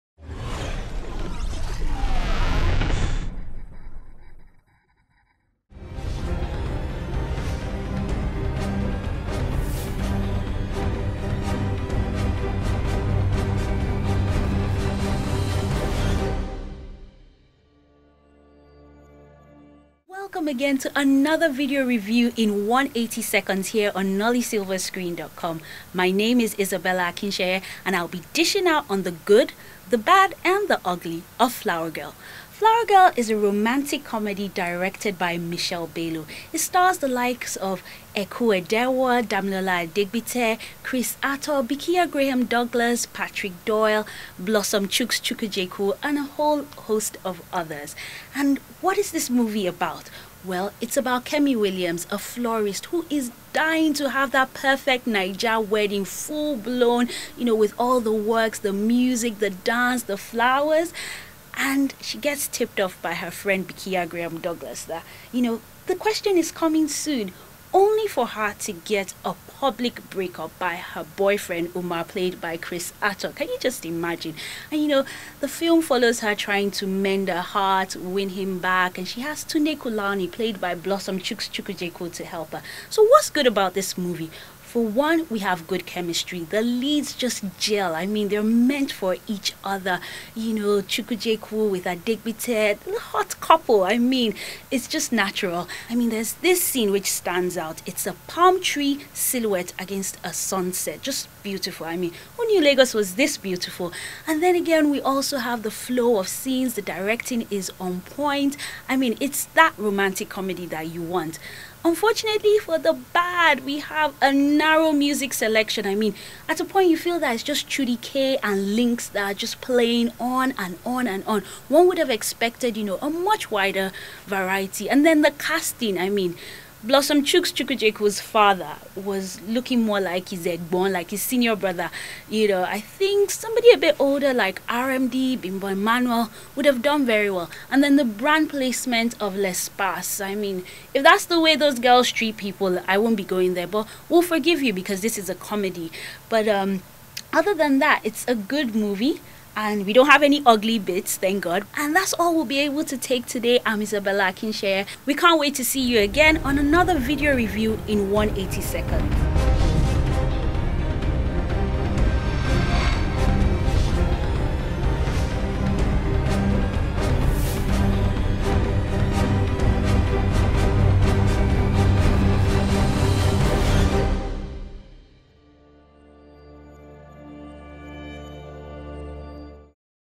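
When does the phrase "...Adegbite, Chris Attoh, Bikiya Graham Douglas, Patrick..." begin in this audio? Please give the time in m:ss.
0:39.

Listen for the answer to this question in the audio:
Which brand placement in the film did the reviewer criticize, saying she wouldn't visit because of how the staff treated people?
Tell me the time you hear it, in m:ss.
2:19.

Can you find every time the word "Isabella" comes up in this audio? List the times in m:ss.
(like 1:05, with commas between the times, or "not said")
0:26, 2:33.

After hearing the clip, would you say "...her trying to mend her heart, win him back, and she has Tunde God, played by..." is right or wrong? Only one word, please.
wrong.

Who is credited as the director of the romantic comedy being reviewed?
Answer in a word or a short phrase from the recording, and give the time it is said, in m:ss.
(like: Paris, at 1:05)
Michelle Bello, at 0:35.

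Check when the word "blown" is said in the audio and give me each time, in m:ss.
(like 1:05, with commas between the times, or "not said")
0:56.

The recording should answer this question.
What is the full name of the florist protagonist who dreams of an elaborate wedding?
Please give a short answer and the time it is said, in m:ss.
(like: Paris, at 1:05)
Kemi Williams, at 0:51.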